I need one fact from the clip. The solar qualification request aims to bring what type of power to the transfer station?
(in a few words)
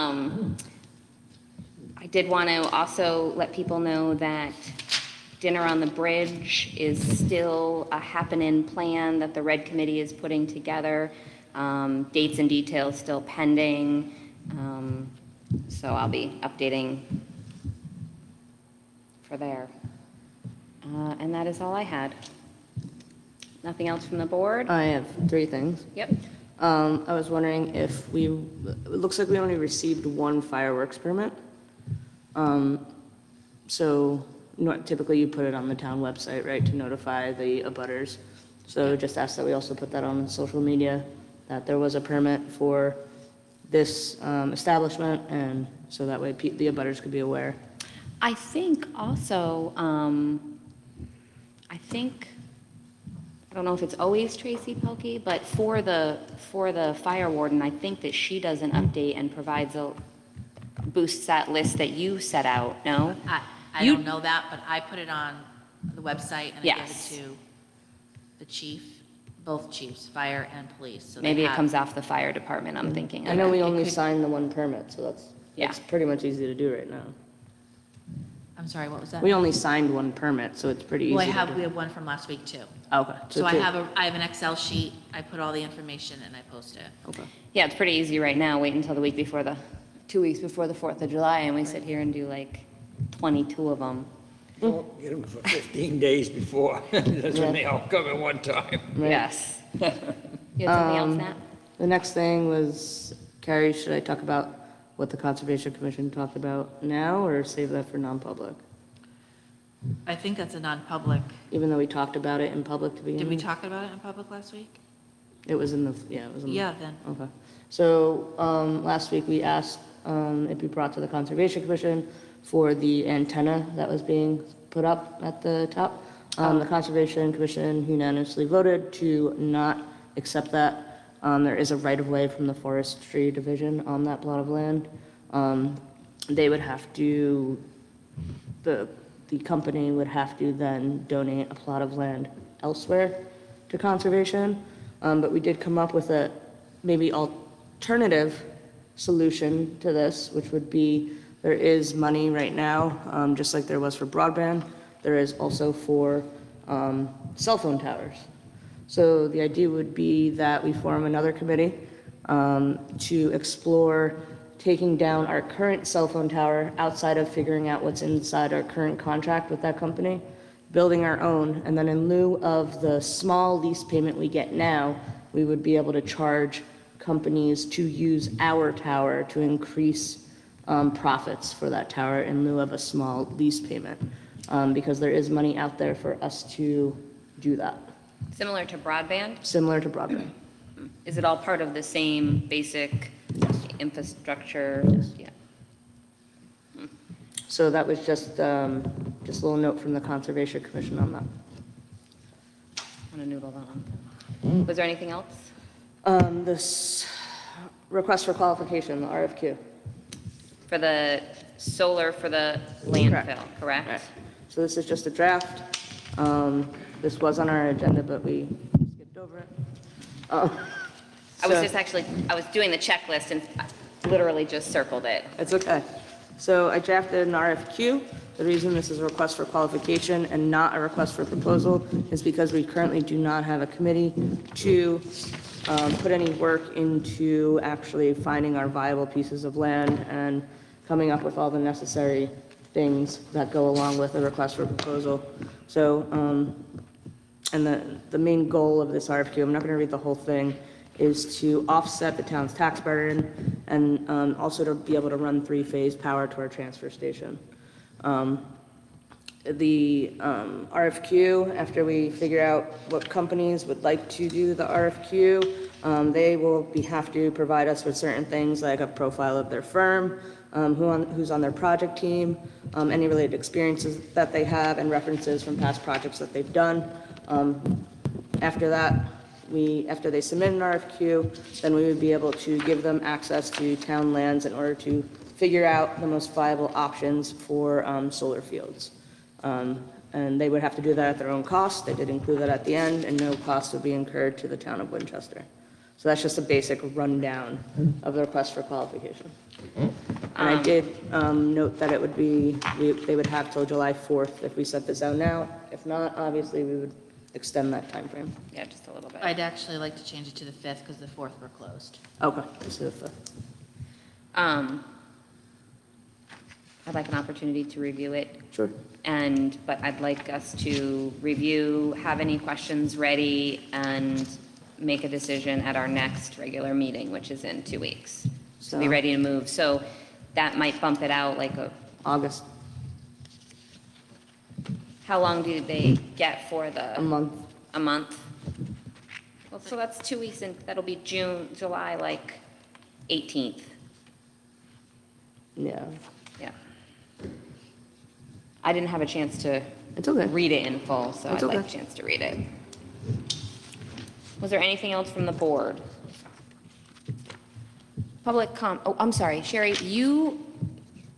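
three-phase power.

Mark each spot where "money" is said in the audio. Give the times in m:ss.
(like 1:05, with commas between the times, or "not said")
2:31, 3:05.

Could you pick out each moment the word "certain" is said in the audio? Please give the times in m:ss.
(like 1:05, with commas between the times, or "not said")
4:27.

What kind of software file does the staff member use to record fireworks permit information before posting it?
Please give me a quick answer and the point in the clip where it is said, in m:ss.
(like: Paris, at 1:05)
Excel sheet, at 1:24.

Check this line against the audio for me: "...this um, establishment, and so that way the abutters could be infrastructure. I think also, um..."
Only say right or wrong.
wrong.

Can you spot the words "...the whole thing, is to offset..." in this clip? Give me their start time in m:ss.
4:09.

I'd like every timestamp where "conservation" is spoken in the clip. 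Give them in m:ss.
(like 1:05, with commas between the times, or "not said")
1:45, 2:01, 2:06, 2:23, 3:20.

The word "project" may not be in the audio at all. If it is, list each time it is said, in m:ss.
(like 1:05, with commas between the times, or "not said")
4:31, 4:35.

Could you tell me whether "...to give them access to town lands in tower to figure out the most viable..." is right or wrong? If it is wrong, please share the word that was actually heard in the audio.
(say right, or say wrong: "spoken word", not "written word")
wrong: "order", not "tower".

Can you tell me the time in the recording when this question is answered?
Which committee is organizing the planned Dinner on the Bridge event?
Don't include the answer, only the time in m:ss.
0:09.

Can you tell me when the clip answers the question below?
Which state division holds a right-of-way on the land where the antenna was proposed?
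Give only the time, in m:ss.
2:12.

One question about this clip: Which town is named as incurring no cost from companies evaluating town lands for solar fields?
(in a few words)
Winchester.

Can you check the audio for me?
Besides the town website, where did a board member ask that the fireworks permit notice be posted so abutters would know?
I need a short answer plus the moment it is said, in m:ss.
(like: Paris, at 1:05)
social media, at 0:40.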